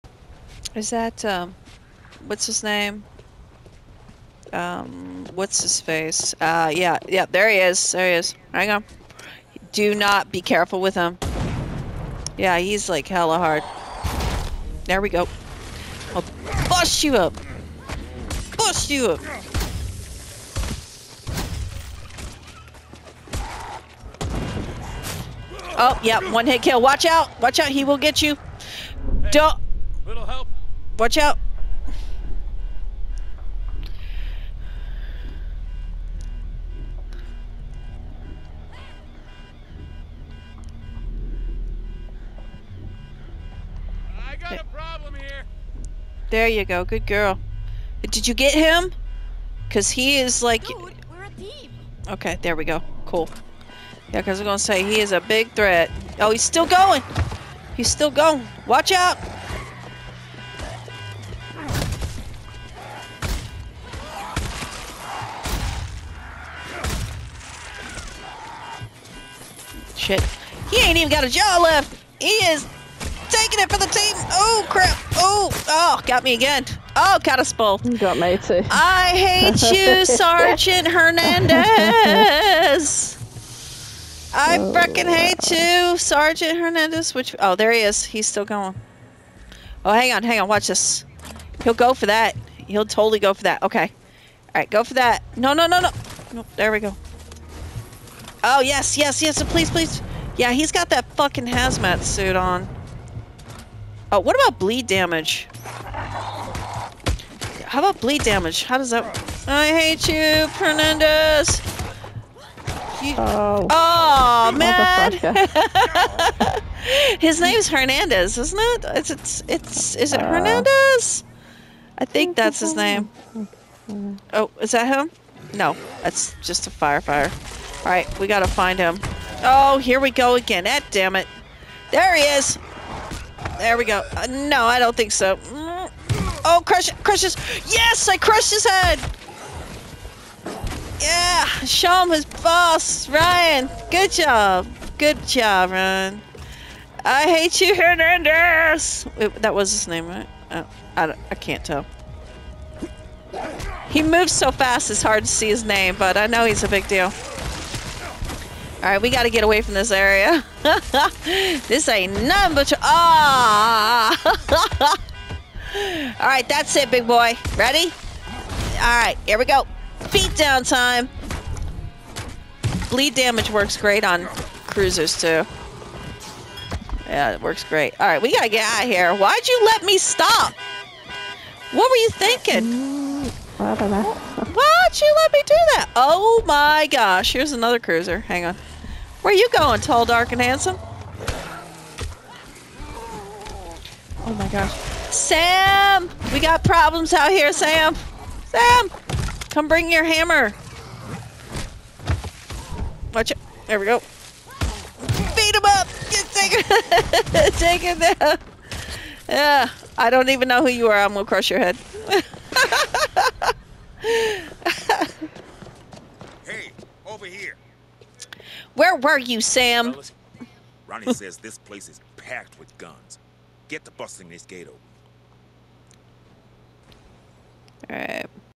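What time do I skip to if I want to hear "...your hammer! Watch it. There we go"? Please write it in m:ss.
3:19.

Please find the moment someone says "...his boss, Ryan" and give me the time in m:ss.
2:22.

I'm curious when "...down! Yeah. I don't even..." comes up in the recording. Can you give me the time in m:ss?
3:28.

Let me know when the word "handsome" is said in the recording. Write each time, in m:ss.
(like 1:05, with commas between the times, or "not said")
3:10.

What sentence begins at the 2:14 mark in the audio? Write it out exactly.
Uh, no, I don't think so.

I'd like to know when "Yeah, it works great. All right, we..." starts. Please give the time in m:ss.
2:57.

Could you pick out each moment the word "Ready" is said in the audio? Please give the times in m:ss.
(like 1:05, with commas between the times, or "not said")
2:47.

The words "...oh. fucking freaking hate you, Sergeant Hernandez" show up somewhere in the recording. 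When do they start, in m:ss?
1:24.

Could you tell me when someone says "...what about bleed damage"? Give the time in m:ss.
1:44.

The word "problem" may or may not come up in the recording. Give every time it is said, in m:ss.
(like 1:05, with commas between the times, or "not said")
0:44, 3:16.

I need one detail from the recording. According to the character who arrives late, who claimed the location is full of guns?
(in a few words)
Ronnie.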